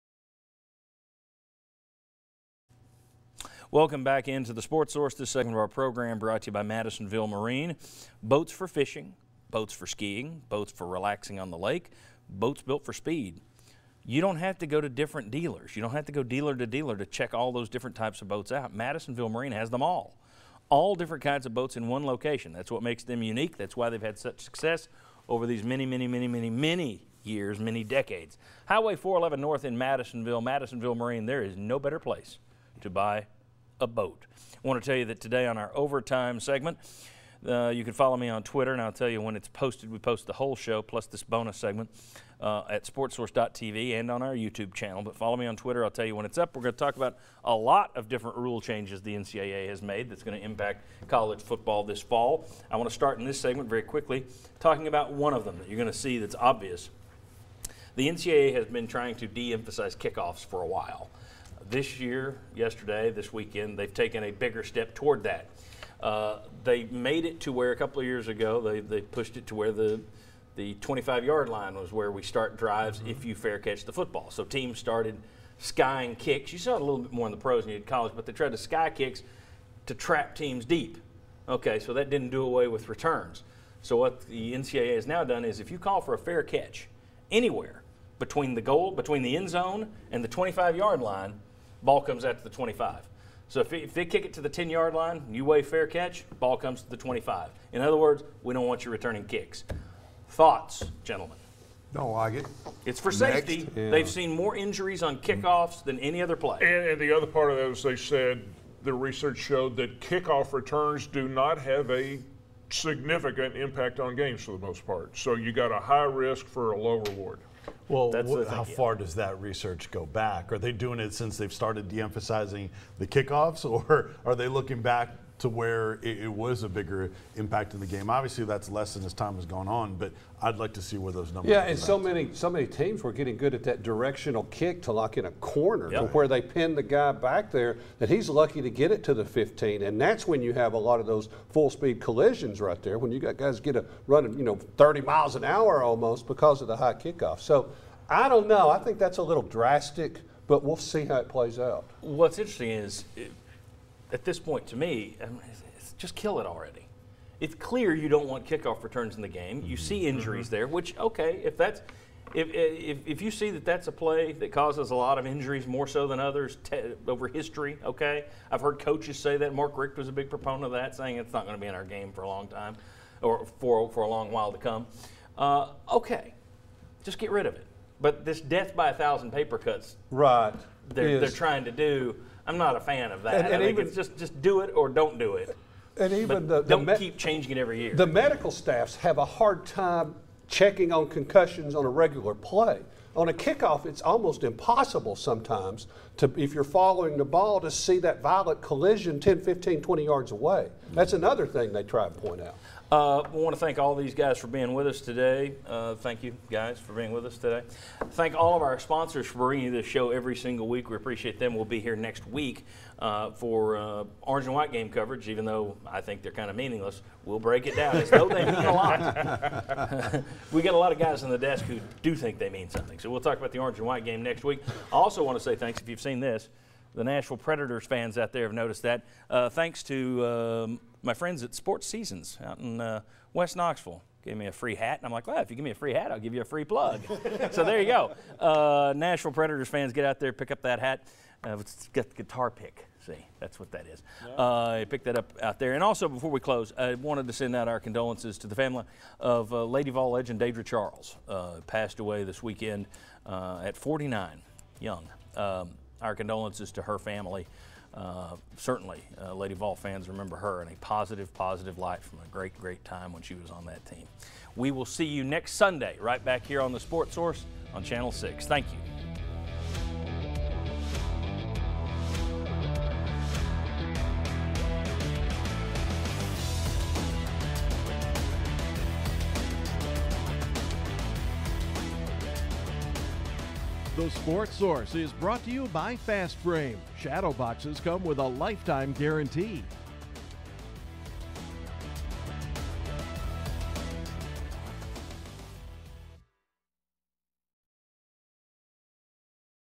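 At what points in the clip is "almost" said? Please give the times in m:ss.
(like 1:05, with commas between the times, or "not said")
2:25, 3:14.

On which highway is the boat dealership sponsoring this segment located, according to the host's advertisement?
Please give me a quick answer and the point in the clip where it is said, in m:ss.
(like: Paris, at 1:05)
Highway 411 North, at 0:28.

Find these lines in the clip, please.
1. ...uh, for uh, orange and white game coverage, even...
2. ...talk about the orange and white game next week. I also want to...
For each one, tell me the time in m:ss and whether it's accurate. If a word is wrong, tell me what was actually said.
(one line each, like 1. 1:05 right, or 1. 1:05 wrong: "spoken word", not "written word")
1. 3:32 right
2. 3:43 right.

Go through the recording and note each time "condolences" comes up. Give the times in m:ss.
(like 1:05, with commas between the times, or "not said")
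4:07, 4:16.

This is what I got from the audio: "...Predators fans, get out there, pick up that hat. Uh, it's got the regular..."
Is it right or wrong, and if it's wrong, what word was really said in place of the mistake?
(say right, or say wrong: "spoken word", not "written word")
wrong: "guitar", not "regular".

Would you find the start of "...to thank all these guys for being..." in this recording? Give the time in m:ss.
3:23.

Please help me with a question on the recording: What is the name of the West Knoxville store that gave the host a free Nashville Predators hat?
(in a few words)
Sports Seasons.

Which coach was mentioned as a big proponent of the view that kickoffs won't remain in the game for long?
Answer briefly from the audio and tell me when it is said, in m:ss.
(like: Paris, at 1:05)
Mark Richt, at 2:49.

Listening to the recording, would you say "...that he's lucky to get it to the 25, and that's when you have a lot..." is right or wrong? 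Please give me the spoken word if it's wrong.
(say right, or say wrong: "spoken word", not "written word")
wrong: "15", not "25".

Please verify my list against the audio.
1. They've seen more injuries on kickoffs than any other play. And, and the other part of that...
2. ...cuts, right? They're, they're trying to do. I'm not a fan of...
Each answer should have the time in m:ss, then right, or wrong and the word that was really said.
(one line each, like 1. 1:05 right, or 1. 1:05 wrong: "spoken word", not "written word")
1. 1:43 right
2. 2:59 right.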